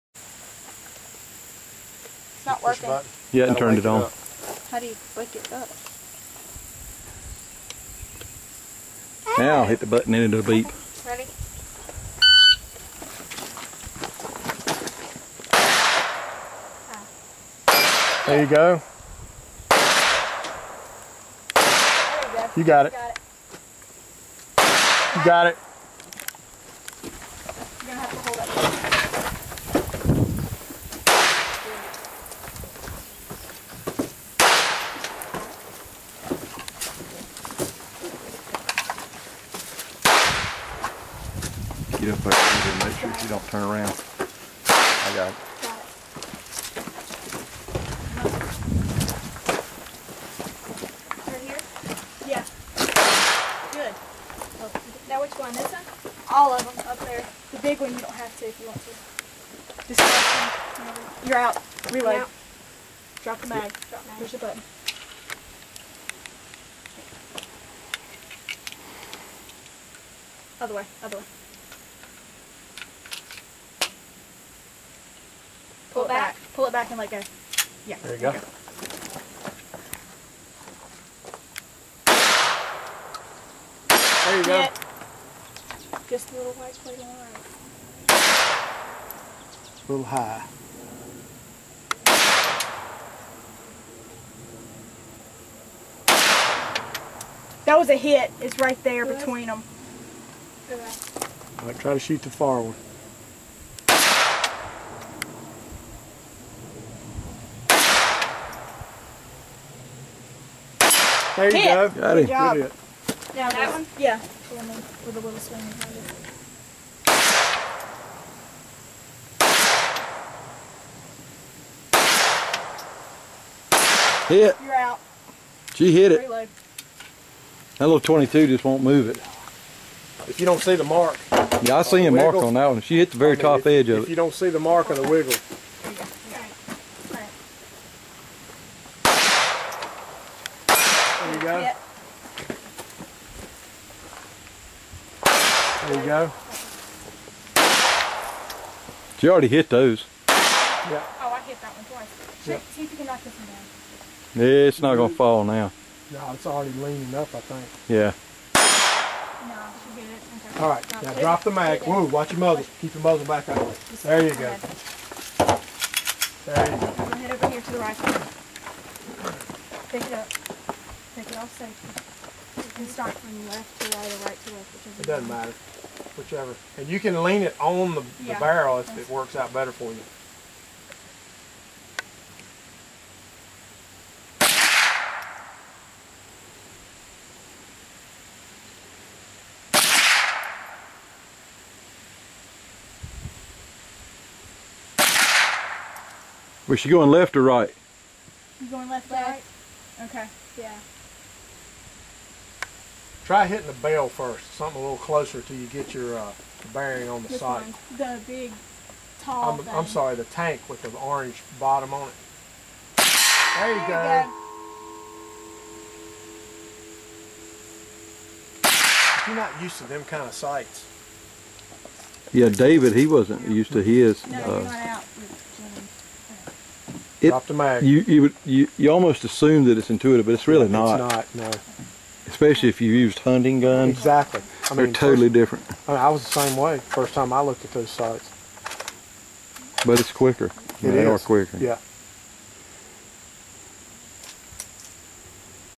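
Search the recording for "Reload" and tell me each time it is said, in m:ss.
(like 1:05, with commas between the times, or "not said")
1:01, 2:06.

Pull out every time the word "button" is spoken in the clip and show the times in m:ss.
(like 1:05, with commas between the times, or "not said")
0:09, 1:04.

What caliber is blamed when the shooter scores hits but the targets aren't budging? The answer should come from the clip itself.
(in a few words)
22.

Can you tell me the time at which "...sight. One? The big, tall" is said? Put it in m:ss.
3:27.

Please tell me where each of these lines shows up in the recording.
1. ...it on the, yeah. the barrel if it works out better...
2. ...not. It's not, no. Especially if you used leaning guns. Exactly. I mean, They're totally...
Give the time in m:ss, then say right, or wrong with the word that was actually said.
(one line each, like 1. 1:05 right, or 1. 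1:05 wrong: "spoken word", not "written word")
1. 2:57 right
2. 3:50 wrong: "hunting", not "leaning".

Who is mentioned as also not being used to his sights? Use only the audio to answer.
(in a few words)
David.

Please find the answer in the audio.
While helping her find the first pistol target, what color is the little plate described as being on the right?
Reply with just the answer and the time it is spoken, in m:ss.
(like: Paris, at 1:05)
white, at 1:26.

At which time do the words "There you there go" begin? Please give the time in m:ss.
3:33.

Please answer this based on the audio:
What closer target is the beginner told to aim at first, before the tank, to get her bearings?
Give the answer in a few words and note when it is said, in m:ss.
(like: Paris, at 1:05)
the bell, at 3:23.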